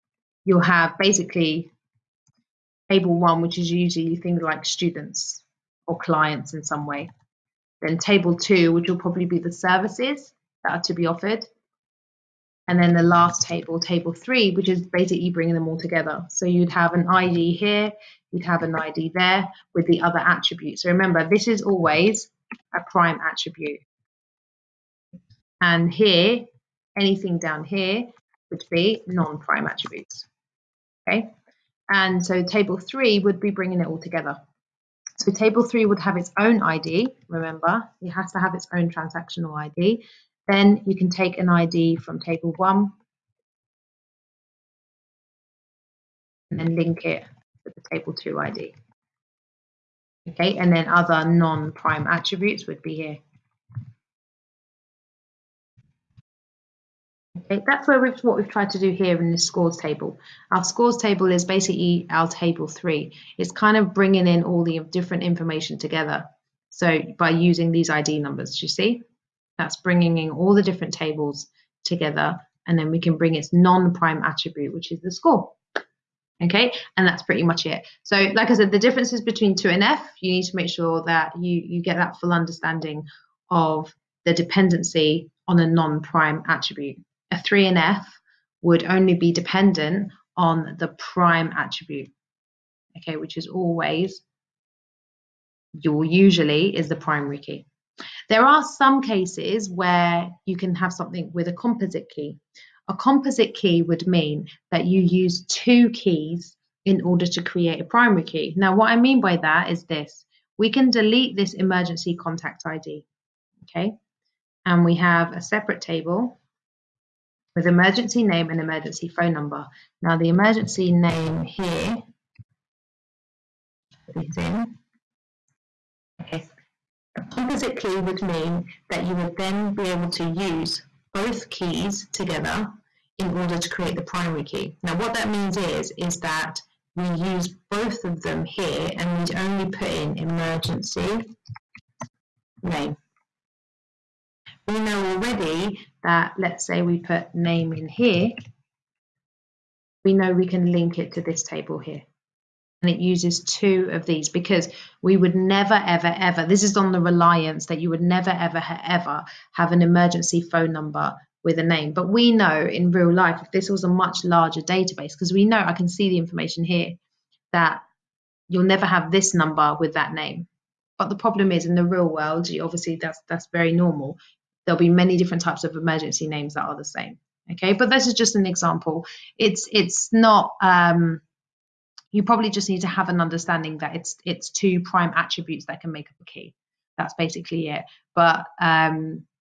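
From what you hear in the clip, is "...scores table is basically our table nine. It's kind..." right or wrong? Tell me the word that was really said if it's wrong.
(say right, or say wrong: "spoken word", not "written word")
wrong: "three", not "nine".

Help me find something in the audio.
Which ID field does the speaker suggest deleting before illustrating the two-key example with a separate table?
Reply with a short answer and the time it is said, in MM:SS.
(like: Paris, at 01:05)
Emergency contact ID, at 01:51.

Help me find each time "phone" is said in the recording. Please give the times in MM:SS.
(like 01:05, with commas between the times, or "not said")
01:59, 02:40.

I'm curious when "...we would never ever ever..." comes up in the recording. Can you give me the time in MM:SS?
02:35.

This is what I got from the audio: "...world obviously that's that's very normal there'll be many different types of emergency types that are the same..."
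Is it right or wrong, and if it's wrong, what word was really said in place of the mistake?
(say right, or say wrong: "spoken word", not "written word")
wrong: "names", not "types".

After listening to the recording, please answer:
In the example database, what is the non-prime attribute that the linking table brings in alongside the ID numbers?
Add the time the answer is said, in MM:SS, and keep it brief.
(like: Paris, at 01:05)
The score, at 01:15.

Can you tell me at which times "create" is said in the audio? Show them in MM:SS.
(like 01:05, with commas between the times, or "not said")
01:47, 02:13.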